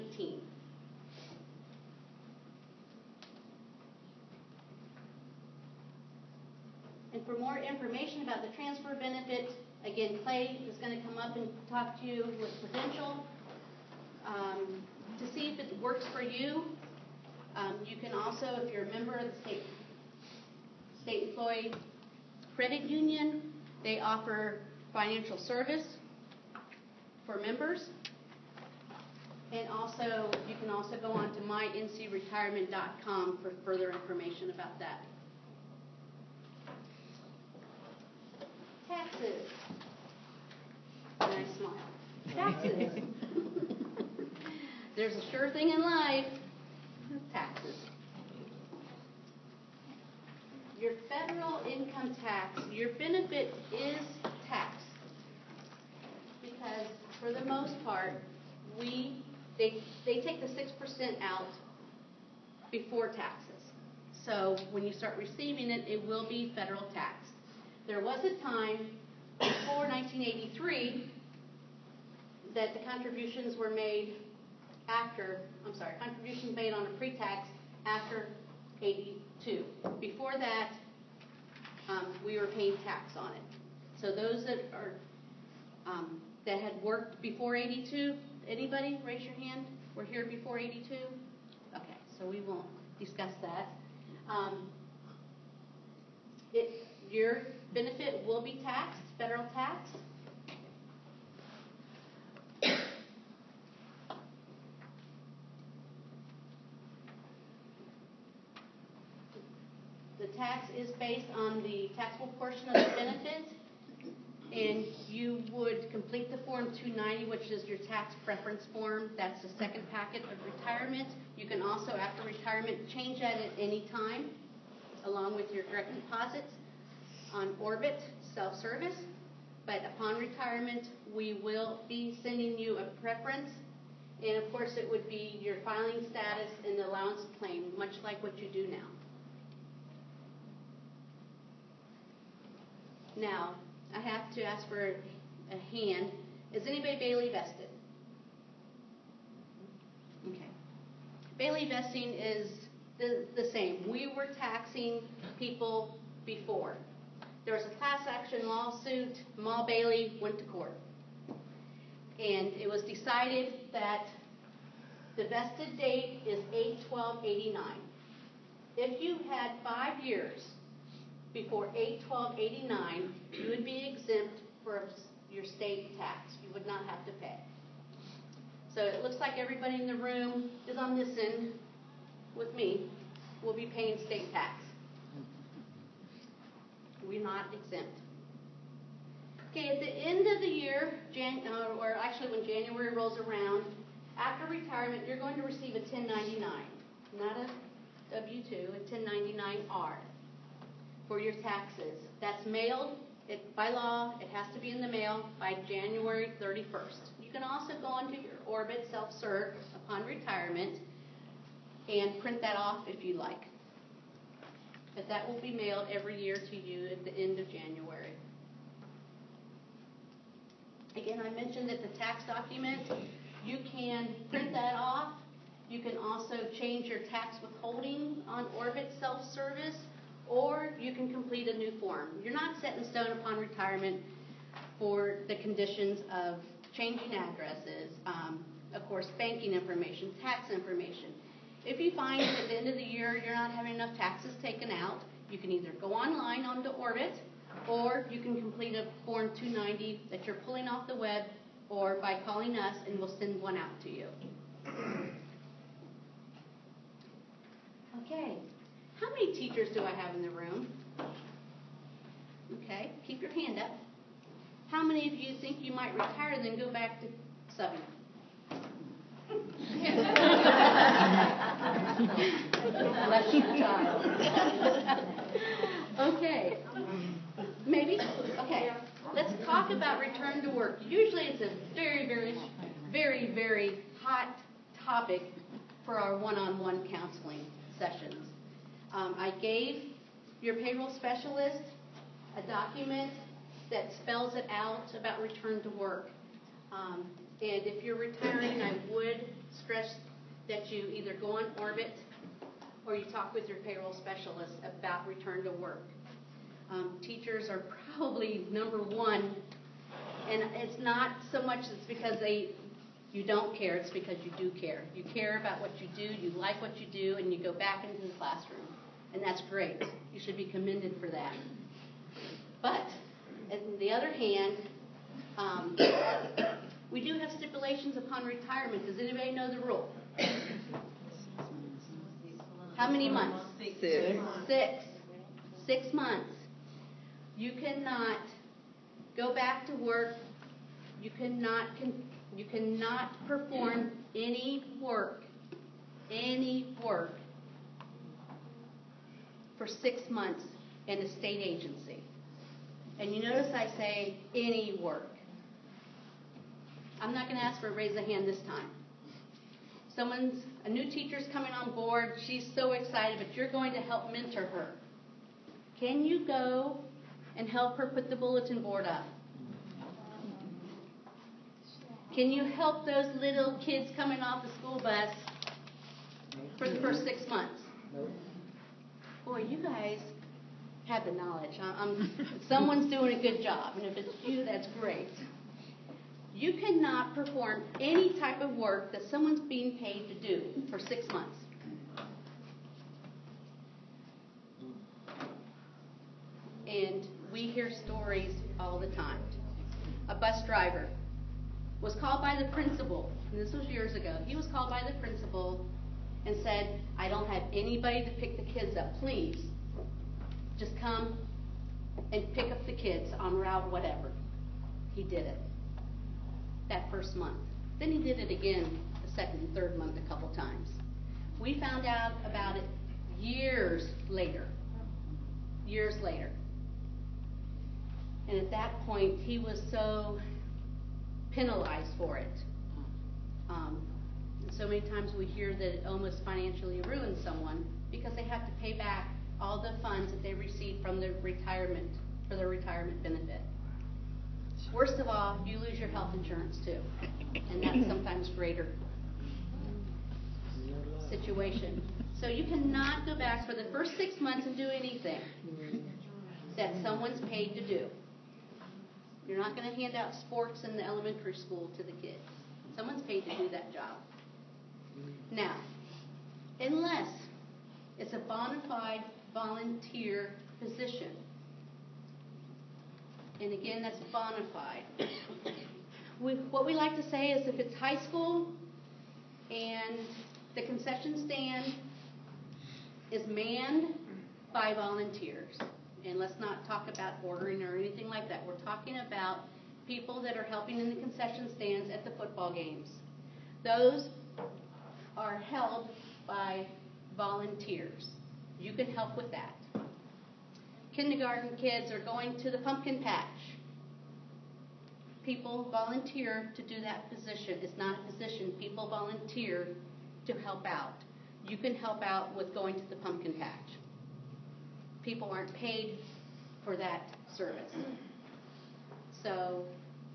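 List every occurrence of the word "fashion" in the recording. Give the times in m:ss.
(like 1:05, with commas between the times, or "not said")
not said.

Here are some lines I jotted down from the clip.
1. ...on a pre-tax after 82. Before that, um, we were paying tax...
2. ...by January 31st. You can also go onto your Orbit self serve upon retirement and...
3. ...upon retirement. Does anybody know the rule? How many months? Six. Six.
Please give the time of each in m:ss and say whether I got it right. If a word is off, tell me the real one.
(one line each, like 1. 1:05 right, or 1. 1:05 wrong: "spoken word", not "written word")
1. 1:16 right
2. 3:25 right
3. 5:27 right.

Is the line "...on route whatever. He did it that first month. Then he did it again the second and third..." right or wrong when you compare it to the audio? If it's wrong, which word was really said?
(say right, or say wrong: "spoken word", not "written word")
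right.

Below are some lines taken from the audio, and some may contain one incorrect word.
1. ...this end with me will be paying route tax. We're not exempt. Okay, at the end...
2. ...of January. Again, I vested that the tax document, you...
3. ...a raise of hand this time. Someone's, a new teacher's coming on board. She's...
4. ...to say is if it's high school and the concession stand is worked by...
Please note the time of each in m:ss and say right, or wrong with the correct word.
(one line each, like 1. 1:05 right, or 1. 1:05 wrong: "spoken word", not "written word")
1. 3:00 wrong: "state", not "route"
2. 3:37 wrong: "mentioned", not "vested"
3. 5:57 right
4. 7:56 wrong: "manned", not "worked".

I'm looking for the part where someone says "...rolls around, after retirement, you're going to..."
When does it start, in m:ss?
3:12.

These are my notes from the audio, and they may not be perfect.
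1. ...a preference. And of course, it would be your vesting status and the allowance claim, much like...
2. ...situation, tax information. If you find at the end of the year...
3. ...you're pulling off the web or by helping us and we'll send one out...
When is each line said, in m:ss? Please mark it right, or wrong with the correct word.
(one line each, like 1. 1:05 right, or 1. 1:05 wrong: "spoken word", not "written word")
1. 2:12 wrong: "filing", not "vesting"
2. 3:59 wrong: "information", not "situation"
3. 4:10 wrong: "calling", not "helping".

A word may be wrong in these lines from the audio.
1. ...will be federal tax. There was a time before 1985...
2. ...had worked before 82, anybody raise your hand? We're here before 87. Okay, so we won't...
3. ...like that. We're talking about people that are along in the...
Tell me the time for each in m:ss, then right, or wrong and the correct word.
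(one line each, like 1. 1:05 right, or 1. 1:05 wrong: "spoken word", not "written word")
1. 1:06 wrong: "1983", not "1985"
2. 1:26 wrong: "82", not "87"
3. 8:08 wrong: "helping", not "along".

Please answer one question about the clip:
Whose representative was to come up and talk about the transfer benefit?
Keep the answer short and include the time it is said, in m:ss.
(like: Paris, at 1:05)
Prudential, at 0:12.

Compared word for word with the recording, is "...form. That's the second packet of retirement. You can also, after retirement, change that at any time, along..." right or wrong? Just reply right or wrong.
right.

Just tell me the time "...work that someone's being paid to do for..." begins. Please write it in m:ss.
6:28.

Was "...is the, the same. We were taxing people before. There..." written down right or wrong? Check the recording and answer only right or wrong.
right.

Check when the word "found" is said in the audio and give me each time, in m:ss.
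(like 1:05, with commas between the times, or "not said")
7:01.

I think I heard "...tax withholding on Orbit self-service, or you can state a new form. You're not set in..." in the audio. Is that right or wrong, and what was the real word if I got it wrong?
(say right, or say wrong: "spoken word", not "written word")
wrong: "complete", not "state".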